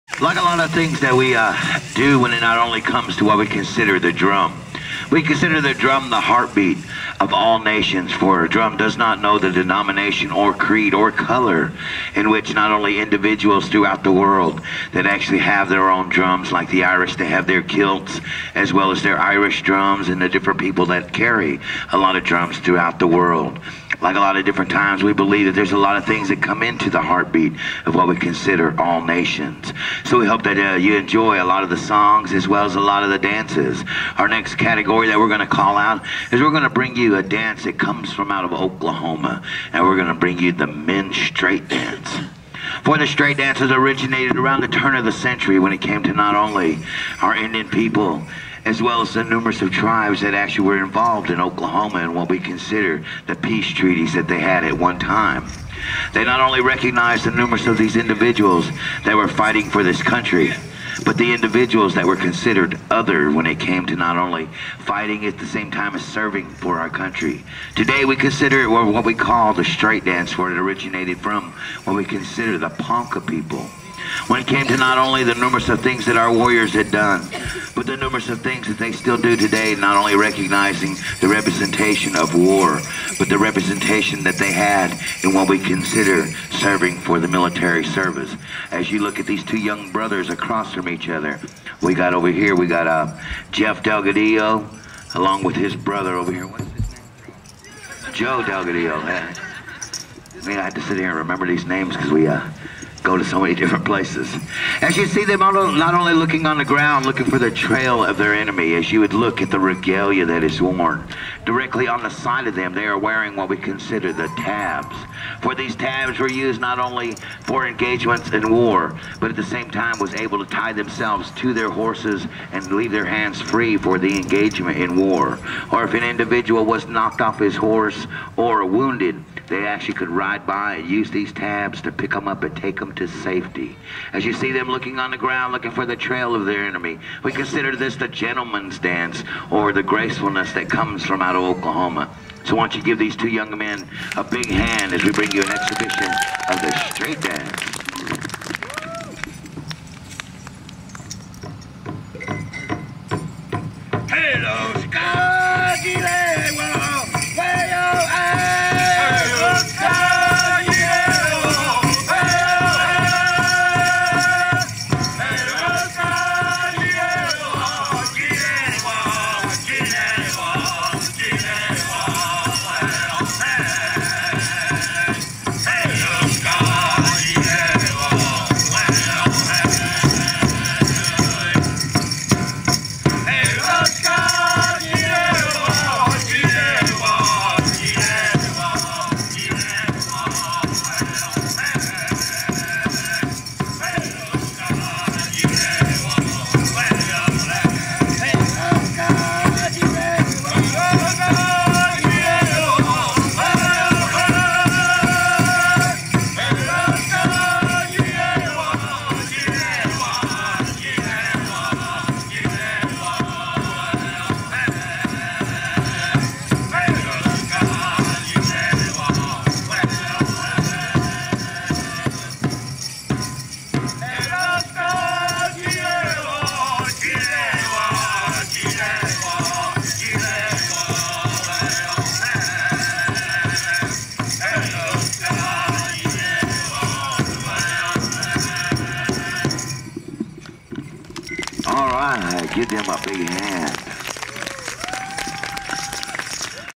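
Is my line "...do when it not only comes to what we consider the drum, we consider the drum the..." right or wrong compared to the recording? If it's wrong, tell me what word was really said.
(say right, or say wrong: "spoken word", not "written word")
right.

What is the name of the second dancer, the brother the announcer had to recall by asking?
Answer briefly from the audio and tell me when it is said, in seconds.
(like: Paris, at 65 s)
Joe Delgadillo, at 98 s.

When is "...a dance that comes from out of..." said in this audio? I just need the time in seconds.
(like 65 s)
37 s.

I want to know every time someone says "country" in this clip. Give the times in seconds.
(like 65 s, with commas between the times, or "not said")
60 s, 66 s.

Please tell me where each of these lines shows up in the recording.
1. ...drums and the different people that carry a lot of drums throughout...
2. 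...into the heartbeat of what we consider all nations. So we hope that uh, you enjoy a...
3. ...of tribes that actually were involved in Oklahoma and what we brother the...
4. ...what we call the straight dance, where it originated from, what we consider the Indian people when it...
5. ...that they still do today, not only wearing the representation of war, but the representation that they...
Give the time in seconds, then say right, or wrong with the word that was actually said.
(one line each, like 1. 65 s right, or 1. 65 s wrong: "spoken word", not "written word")
1. 19 s right
2. 26 s right
3. 49 s wrong: "consider", not "brother"
4. 68 s wrong: "Ponca", not "Indian"
5. 78 s wrong: "recognizing", not "wearing".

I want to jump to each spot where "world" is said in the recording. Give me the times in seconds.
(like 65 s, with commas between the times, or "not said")
14 s, 23 s.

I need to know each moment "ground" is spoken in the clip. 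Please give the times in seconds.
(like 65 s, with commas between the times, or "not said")
106 s, 135 s.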